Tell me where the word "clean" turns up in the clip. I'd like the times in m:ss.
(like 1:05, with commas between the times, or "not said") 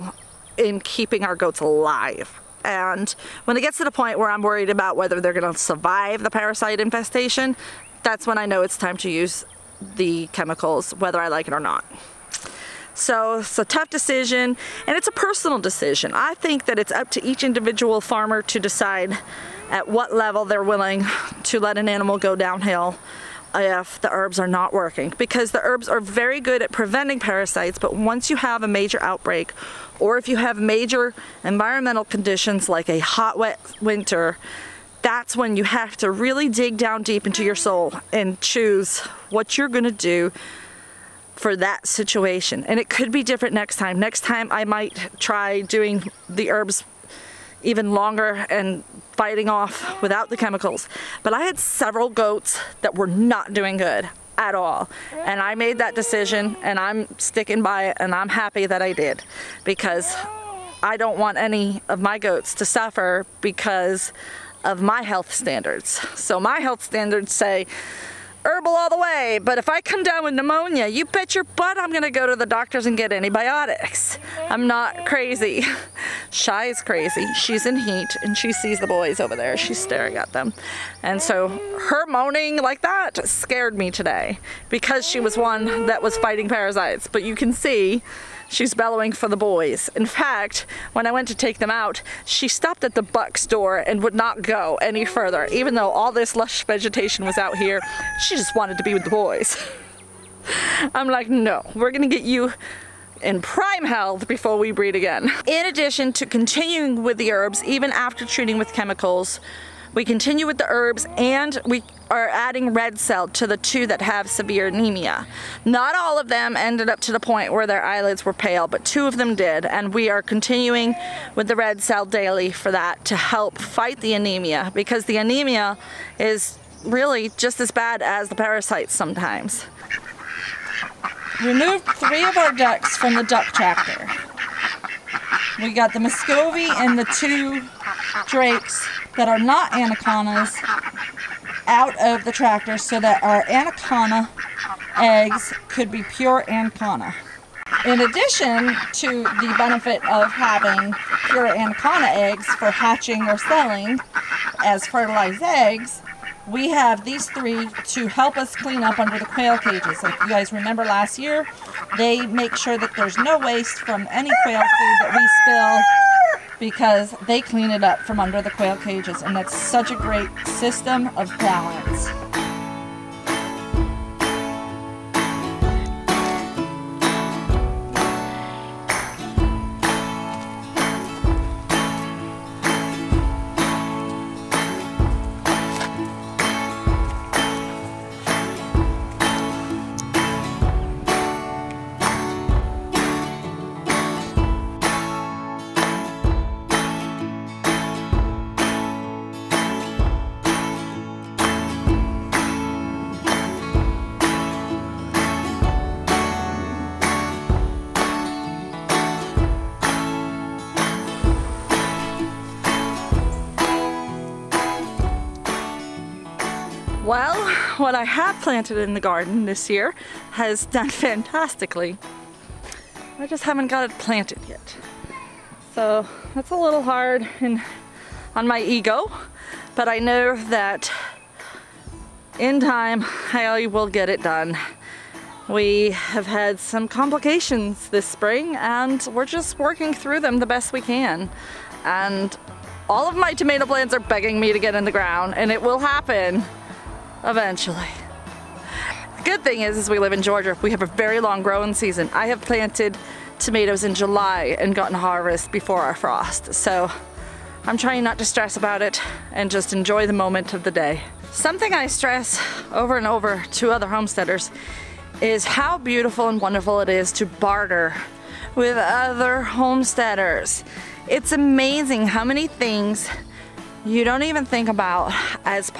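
2:38, 2:47.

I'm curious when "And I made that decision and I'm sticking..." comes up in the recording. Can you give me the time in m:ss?
0:55.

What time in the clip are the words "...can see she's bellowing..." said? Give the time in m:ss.
1:27.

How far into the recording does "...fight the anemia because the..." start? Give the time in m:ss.
2:03.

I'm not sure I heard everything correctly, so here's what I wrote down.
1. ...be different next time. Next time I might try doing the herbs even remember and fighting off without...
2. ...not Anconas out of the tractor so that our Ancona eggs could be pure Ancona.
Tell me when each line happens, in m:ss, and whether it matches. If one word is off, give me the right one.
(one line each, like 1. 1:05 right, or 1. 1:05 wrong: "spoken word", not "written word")
1. 0:43 wrong: "longer", not "remember"
2. 2:19 right.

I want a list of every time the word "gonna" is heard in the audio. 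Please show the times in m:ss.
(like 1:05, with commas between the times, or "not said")
0:05, 1:11, 1:41.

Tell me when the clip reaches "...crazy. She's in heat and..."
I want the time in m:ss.
1:16.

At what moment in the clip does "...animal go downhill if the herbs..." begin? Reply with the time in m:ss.
0:21.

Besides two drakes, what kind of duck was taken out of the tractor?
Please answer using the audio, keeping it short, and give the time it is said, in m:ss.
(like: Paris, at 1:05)
Muscovy, at 2:15.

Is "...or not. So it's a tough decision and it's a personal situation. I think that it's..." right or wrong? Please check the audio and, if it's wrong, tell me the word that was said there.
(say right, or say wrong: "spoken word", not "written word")
wrong: "decision", not "situation".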